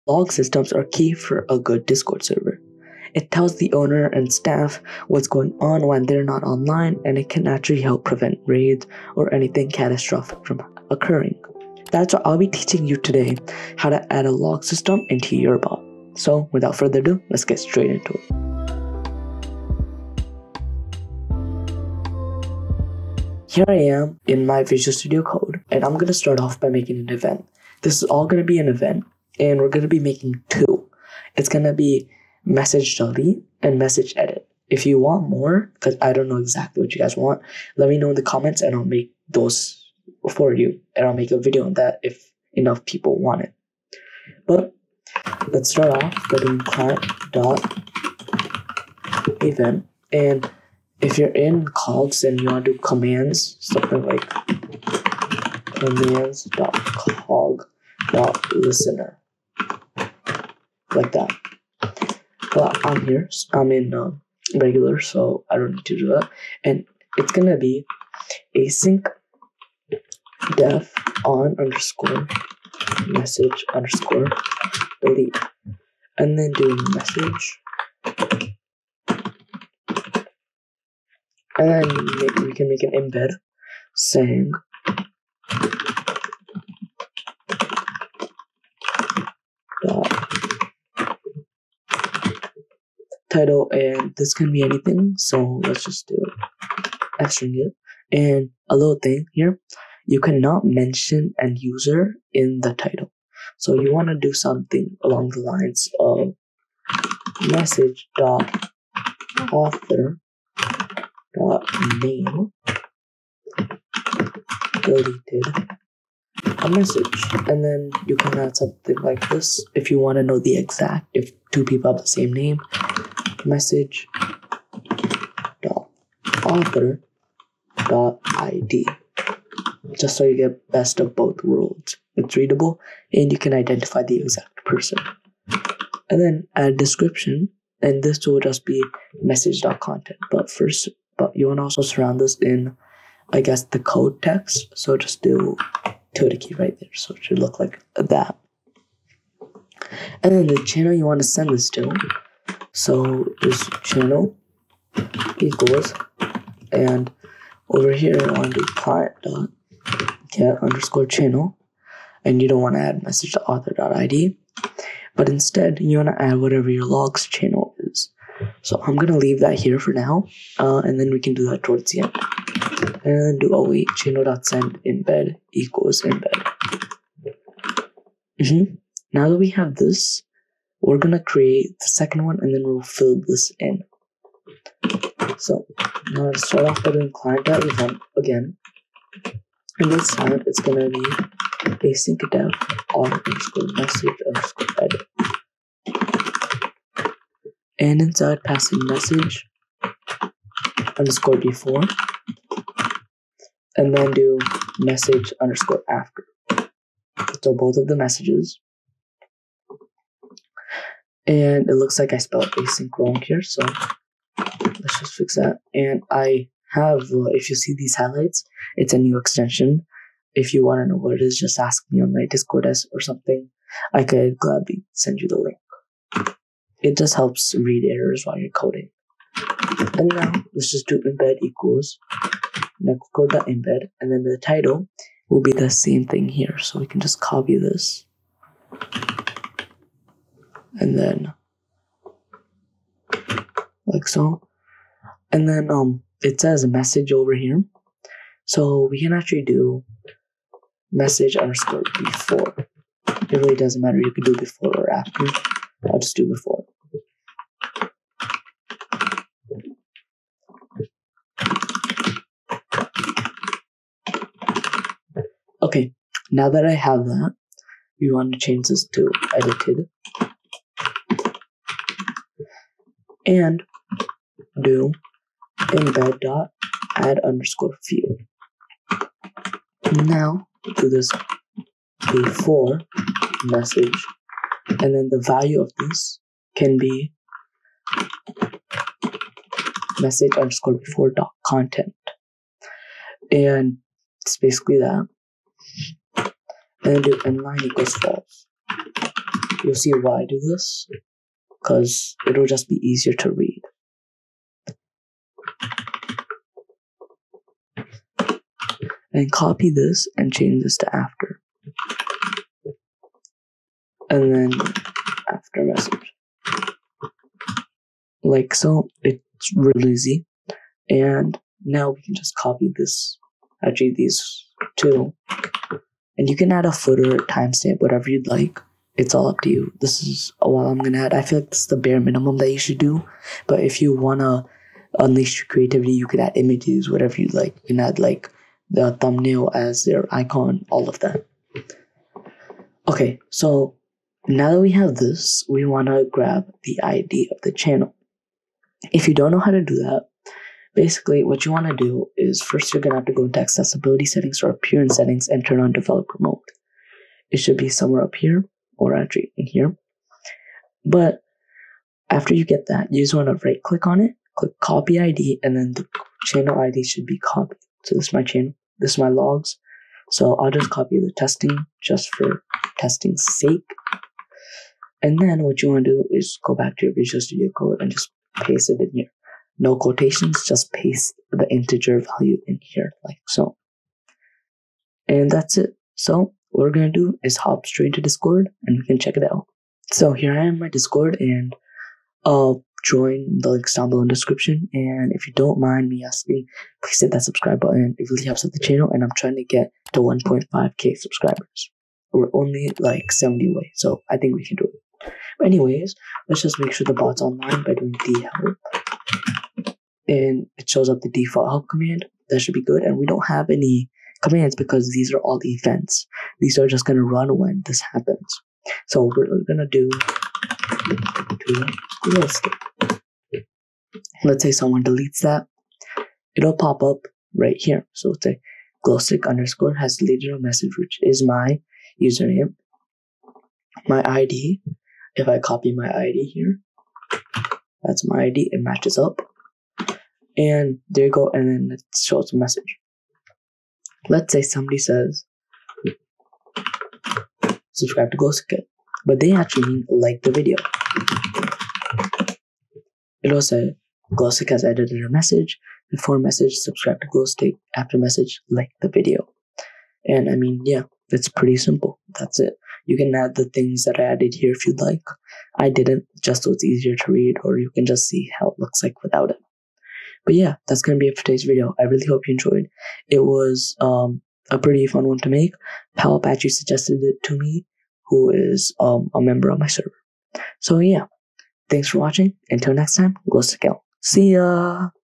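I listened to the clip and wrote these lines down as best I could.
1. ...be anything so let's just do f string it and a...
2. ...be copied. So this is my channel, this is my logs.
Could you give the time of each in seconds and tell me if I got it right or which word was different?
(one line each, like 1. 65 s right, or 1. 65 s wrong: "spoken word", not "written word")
1. 94 s right
2. 367 s right.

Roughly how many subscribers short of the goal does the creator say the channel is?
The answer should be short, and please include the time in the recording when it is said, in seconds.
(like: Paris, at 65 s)
70, at 403 s.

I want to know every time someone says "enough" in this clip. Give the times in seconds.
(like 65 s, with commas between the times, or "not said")
42 s.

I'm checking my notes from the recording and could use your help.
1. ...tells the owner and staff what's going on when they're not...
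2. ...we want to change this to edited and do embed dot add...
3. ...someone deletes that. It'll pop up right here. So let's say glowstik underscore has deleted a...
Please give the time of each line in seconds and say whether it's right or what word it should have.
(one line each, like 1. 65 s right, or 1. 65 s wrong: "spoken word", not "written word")
1. 3 s right
2. 268 s right
3. 424 s right.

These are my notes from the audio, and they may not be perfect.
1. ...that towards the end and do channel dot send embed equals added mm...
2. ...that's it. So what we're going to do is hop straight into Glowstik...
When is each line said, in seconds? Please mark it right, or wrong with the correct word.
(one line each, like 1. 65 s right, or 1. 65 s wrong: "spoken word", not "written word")
1. 171 s wrong: "embed", not "added"
2. 385 s wrong: "Discord", not "Glowstik".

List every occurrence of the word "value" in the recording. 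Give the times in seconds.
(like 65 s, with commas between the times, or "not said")
285 s, 382 s.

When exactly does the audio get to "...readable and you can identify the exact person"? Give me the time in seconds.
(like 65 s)
132 s.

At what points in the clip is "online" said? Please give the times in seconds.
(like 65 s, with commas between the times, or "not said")
6 s, 407 s.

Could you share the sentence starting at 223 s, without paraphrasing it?
I could gladly send you the link.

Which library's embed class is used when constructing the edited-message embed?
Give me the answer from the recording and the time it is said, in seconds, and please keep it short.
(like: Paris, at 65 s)
Nextcord, at 232 s.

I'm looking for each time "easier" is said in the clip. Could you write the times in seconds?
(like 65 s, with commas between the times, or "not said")
302 s, 466 s.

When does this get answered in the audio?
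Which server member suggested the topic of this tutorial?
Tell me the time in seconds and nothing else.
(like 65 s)
475 s.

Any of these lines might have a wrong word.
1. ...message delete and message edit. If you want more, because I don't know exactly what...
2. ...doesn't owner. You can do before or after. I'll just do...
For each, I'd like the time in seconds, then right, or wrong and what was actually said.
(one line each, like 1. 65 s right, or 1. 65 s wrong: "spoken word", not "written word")
1. 32 s right
2. 253 s wrong: "matter", not "owner".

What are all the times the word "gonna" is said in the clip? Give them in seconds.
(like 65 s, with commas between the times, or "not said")
67 s, 180 s, 190 s, 330 s, 352 s, 470 s.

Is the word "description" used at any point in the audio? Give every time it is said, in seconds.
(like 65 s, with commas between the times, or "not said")
136 s, 394 s.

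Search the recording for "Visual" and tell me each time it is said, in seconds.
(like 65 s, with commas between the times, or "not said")
24 s, 376 s.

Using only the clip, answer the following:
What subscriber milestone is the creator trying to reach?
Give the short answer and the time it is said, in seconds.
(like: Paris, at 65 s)
1.5k, at 400 s.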